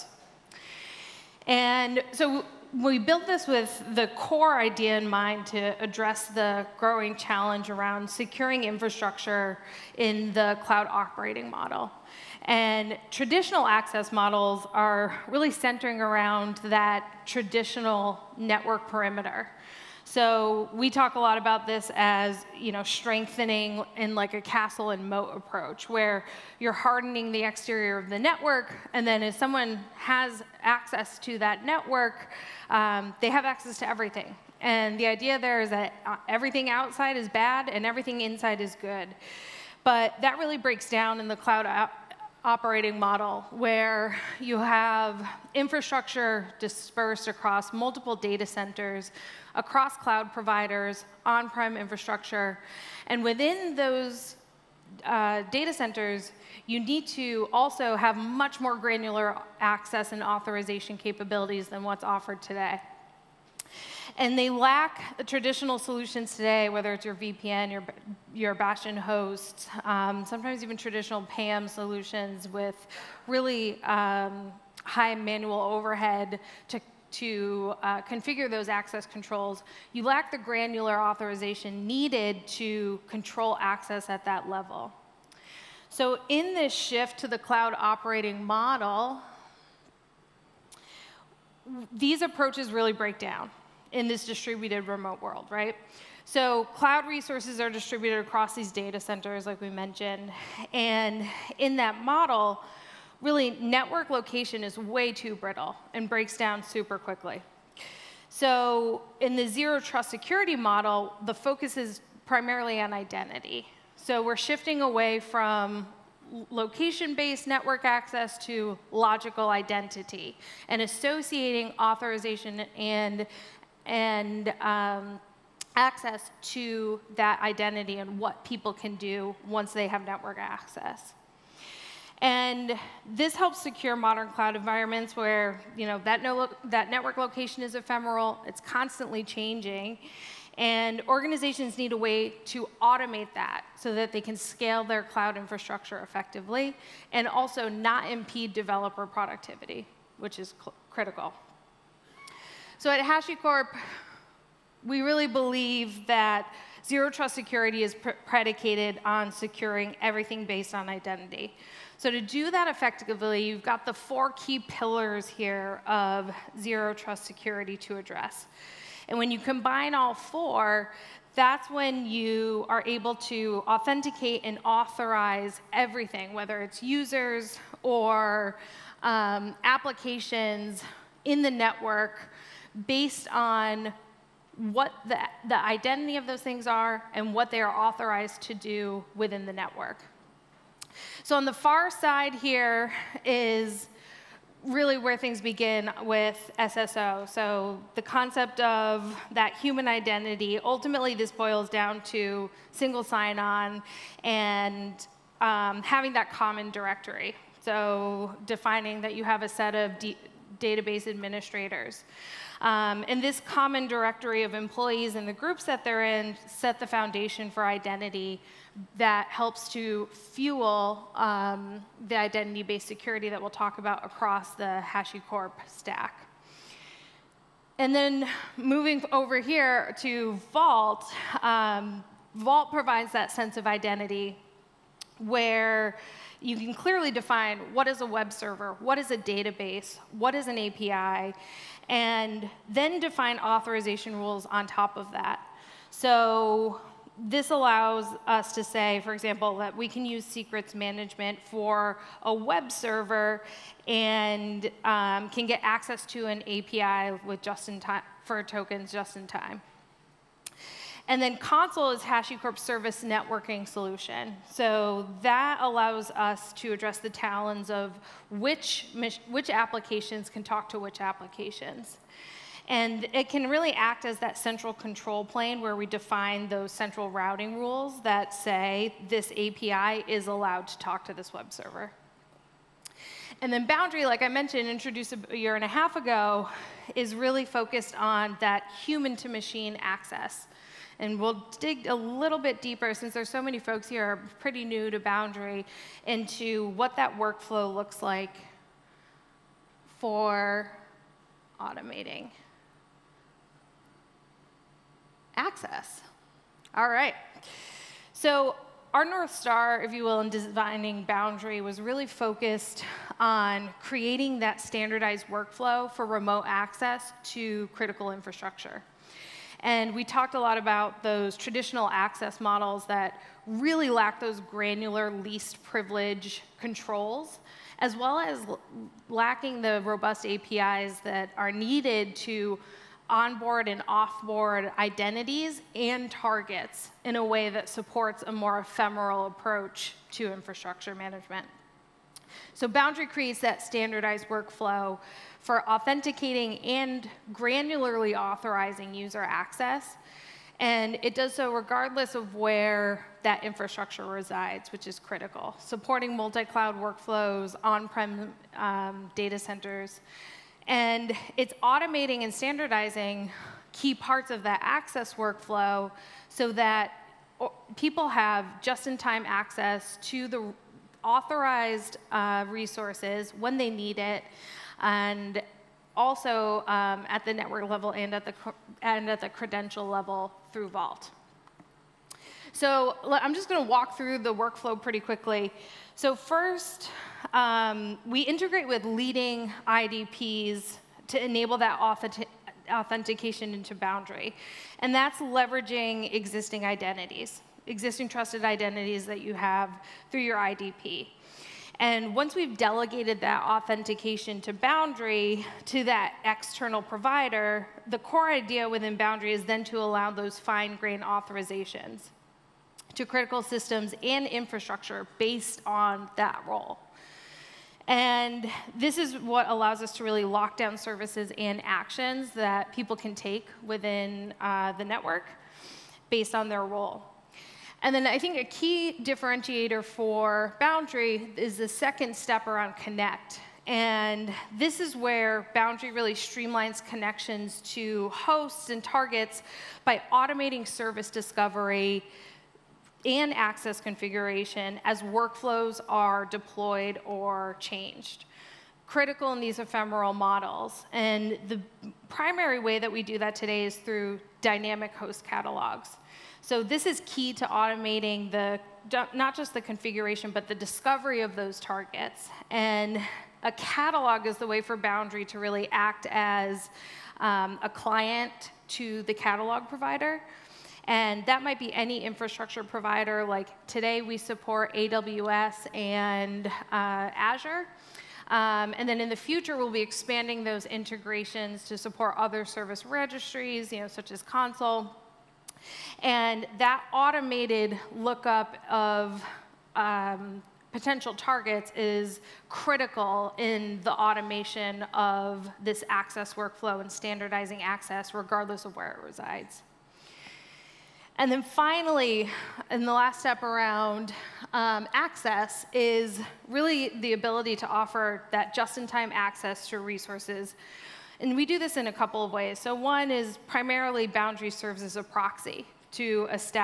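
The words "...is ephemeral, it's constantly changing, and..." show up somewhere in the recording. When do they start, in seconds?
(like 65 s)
137 s.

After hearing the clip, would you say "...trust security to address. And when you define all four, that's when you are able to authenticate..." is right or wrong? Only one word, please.
wrong.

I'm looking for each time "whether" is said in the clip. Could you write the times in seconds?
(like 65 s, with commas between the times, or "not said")
66 s, 176 s.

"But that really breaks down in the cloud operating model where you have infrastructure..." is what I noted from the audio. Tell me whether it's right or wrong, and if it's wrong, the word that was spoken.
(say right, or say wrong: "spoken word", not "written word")
right.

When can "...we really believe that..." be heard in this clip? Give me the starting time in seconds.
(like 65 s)
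154 s.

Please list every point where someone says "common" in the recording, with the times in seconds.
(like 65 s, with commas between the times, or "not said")
206 s, 213 s.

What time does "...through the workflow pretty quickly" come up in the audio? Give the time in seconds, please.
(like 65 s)
383 s.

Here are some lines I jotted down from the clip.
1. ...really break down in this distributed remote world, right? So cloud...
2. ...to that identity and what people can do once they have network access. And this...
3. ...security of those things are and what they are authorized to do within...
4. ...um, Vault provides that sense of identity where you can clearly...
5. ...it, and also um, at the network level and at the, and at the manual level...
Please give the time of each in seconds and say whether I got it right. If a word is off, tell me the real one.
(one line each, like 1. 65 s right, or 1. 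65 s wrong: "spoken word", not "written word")
1. 92 s right
2. 126 s right
3. 185 s wrong: "identity", not "security"
4. 231 s right
5. 373 s wrong: "credential", not "manual".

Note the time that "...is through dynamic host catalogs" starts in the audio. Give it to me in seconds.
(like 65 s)
453 s.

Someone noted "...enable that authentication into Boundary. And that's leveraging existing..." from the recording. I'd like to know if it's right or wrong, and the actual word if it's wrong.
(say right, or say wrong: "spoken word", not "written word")
right.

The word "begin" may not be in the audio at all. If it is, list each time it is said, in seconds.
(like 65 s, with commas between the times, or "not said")
195 s.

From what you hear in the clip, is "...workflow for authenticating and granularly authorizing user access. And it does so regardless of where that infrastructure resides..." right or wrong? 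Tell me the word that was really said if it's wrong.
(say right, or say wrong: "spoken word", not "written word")
right.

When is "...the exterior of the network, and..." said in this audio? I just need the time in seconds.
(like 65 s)
27 s.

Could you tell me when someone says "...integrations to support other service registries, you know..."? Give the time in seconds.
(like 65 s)
480 s.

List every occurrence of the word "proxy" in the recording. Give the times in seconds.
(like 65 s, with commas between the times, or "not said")
515 s.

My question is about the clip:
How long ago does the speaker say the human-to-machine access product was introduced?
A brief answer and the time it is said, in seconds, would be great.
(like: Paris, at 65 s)
a year and a half, at 285 s.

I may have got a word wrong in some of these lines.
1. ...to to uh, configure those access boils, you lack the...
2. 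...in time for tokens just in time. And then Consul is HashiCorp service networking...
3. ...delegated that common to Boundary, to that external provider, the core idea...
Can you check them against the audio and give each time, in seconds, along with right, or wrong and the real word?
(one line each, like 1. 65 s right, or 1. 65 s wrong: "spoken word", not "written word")
1. 76 s wrong: "controls", not "boils"
2. 257 s right
3. 402 s wrong: "authentication", not "common".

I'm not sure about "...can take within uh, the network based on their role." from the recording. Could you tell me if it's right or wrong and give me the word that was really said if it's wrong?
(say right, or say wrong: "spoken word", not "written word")
right.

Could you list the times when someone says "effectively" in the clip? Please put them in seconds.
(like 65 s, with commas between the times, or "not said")
145 s, 162 s.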